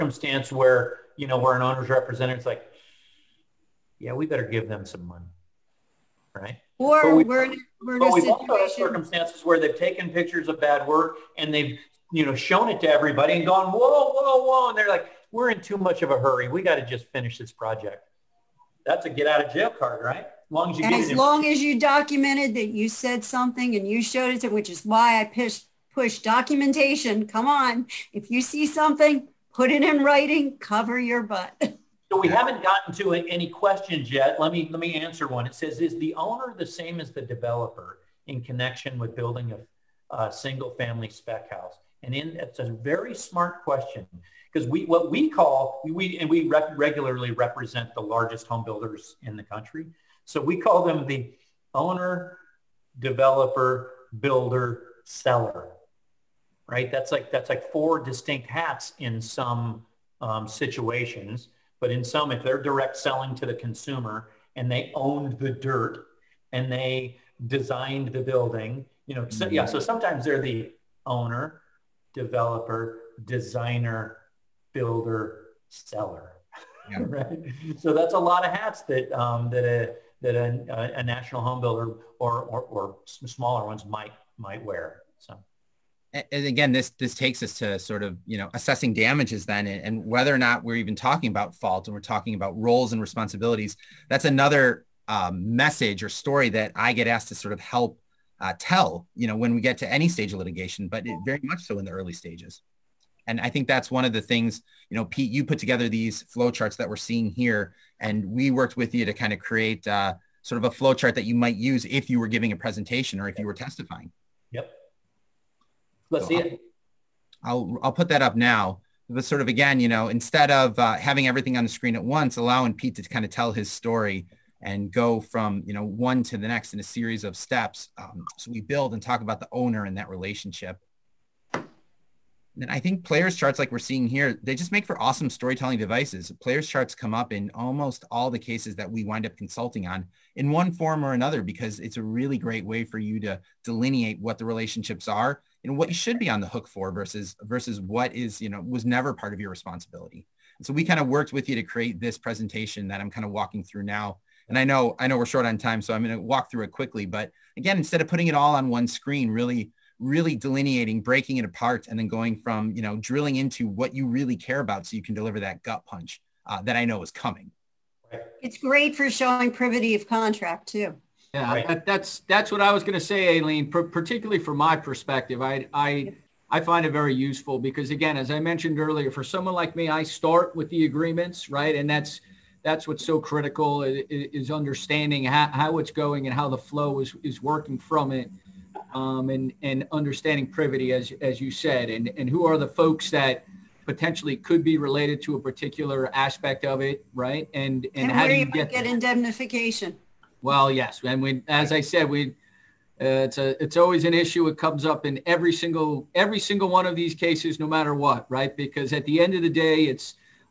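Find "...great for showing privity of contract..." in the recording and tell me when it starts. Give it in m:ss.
2:48.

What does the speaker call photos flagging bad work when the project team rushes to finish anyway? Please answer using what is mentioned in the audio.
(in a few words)
get out of jail card.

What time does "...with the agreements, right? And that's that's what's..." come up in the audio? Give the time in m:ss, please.
3:00.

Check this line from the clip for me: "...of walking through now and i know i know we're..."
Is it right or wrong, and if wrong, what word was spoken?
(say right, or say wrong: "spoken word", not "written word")
right.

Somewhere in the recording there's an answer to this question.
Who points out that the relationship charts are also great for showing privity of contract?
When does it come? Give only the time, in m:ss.
2:53.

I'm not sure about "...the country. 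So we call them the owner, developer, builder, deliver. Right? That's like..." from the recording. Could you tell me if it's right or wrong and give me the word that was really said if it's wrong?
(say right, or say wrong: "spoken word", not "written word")
wrong: "seller", not "deliver".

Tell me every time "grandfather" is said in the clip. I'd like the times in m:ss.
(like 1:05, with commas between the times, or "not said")
not said.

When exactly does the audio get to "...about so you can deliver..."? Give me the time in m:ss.
2:44.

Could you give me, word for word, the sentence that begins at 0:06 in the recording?
Or we, we're, we're in a situation.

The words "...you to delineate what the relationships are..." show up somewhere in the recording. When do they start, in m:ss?
2:22.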